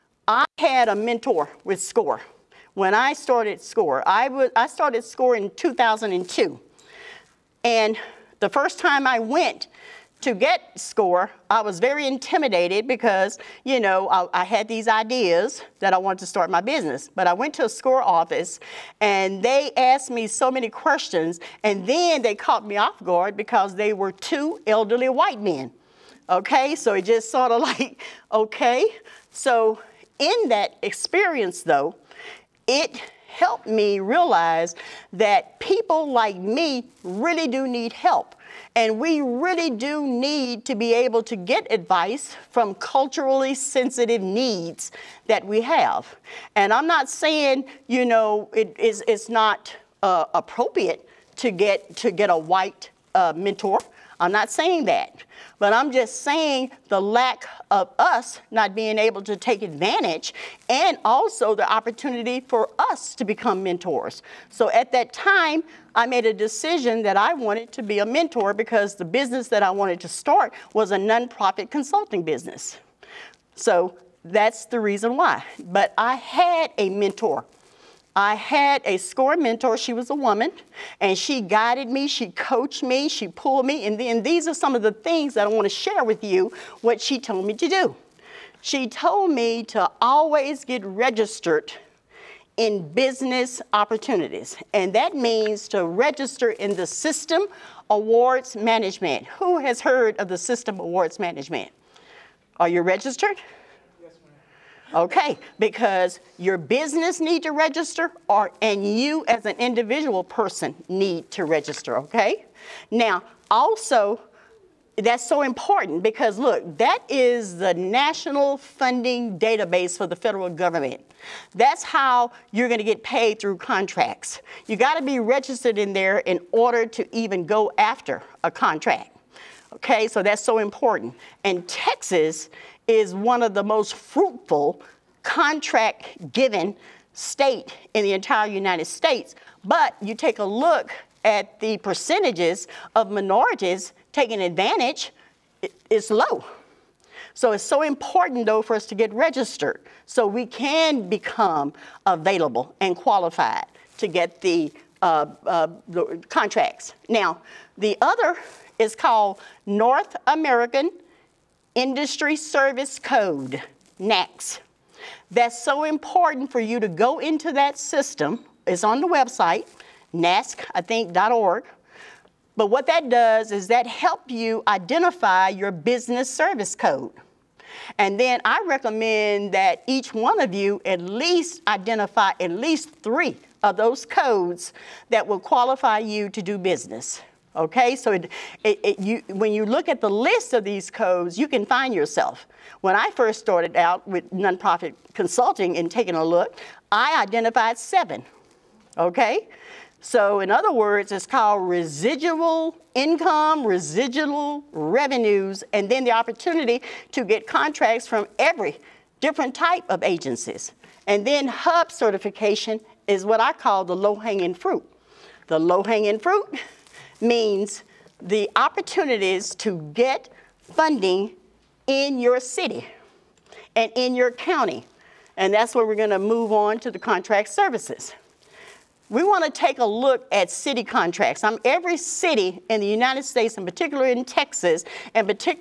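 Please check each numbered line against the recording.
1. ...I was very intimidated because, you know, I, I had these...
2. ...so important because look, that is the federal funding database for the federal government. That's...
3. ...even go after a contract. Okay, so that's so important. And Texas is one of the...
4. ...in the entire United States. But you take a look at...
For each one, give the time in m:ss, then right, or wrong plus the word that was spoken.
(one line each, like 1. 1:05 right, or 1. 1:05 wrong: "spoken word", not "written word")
1. 0:11 right
2. 1:55 wrong: "national", not "federal"
3. 2:07 right
4. 2:17 right.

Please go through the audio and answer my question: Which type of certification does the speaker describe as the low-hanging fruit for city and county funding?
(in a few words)
HUB certification.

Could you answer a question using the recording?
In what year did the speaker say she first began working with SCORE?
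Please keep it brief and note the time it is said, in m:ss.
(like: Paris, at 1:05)
2002, at 0:05.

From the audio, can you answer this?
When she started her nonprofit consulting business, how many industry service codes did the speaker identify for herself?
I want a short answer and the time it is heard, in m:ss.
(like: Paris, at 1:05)
7, at 3:17.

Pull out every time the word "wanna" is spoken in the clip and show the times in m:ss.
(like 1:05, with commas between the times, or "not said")
3:49.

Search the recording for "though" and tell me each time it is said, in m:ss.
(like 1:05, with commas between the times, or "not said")
0:31, 2:28.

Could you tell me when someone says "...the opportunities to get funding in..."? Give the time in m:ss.
3:38.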